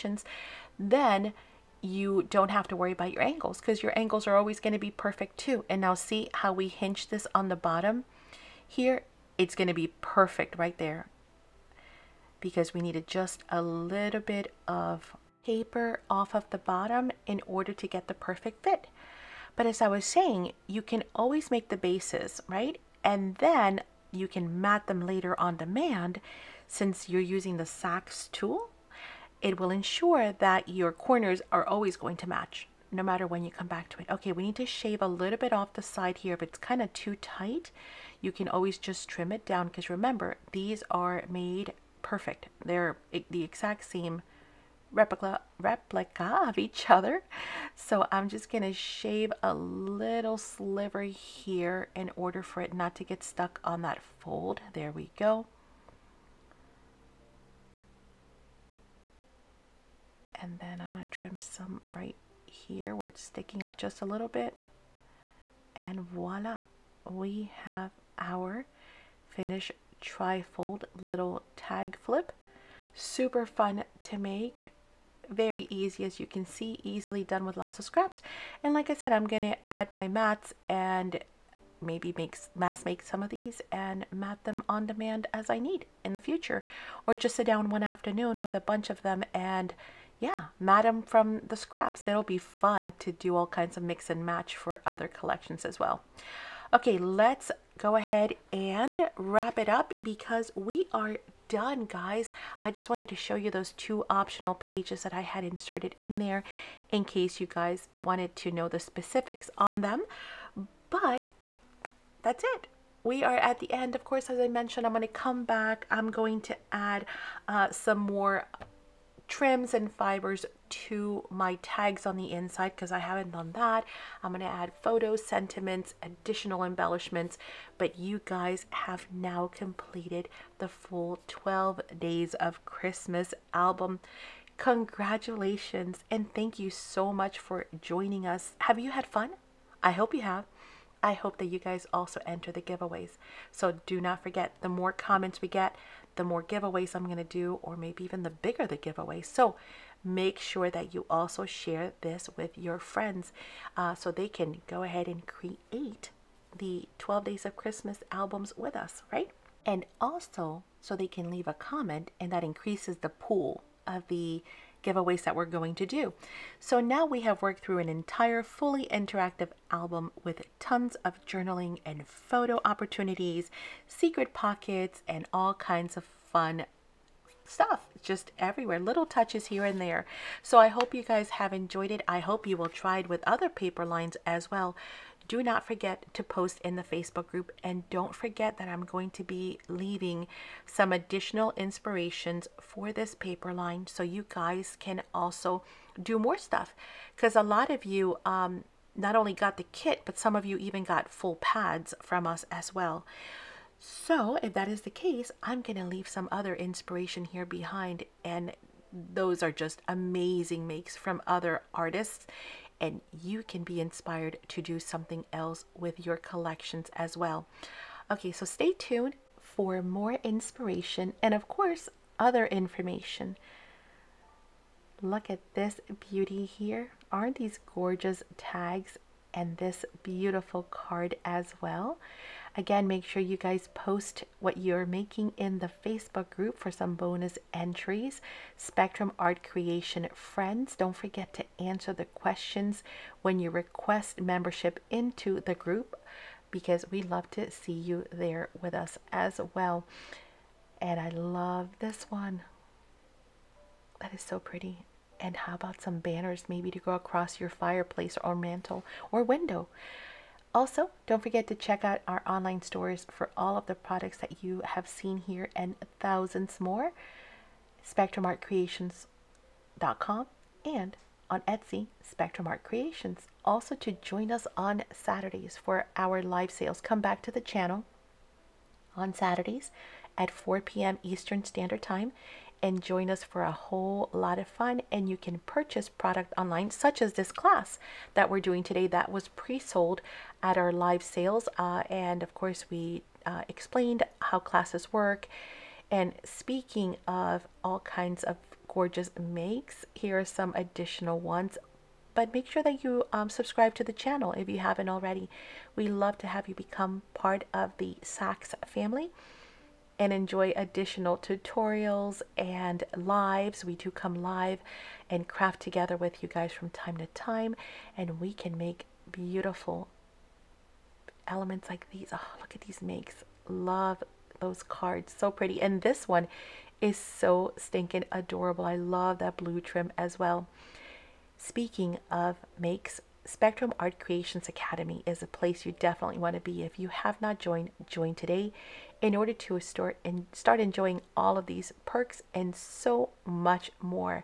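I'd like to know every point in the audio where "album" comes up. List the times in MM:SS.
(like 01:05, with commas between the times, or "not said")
02:13, 02:38, 02:49.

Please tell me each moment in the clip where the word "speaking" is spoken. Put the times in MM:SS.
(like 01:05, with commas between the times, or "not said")
04:56, 05:31.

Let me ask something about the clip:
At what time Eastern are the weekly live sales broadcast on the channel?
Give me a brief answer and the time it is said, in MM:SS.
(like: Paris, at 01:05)
4 p.m., at 04:40.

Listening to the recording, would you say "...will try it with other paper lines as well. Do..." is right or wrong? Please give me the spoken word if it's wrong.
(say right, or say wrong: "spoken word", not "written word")
right.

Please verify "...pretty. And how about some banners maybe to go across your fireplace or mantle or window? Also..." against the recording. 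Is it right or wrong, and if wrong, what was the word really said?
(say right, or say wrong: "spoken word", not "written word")
right.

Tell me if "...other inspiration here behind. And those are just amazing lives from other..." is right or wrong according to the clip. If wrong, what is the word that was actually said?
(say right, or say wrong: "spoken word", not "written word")
wrong: "makes", not "lives".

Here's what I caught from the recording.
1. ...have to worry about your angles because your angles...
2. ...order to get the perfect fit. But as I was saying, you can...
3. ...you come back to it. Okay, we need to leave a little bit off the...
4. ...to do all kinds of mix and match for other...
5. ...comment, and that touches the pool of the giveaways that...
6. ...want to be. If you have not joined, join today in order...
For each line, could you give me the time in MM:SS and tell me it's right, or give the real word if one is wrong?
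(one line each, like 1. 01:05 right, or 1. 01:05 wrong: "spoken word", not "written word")
1. 00:02 right
2. 00:17 right
3. 00:33 wrong: "shave", not "leave"
4. 01:32 right
5. 02:41 wrong: "increases", not "touches"
6. 05:36 right.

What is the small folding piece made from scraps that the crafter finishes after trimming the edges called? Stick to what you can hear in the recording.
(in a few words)
trifold little tag flip.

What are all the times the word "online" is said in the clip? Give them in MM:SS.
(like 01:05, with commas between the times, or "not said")
04:22, 04:46.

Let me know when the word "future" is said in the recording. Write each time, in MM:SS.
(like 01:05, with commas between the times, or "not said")
01:26.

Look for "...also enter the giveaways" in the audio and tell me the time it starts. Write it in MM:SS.
02:21.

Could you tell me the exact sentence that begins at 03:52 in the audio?
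Again, make sure you guys post what you're making in the Facebook group for some bonus entries.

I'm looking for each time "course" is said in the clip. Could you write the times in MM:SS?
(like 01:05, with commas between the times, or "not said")
01:54, 03:41, 04:52.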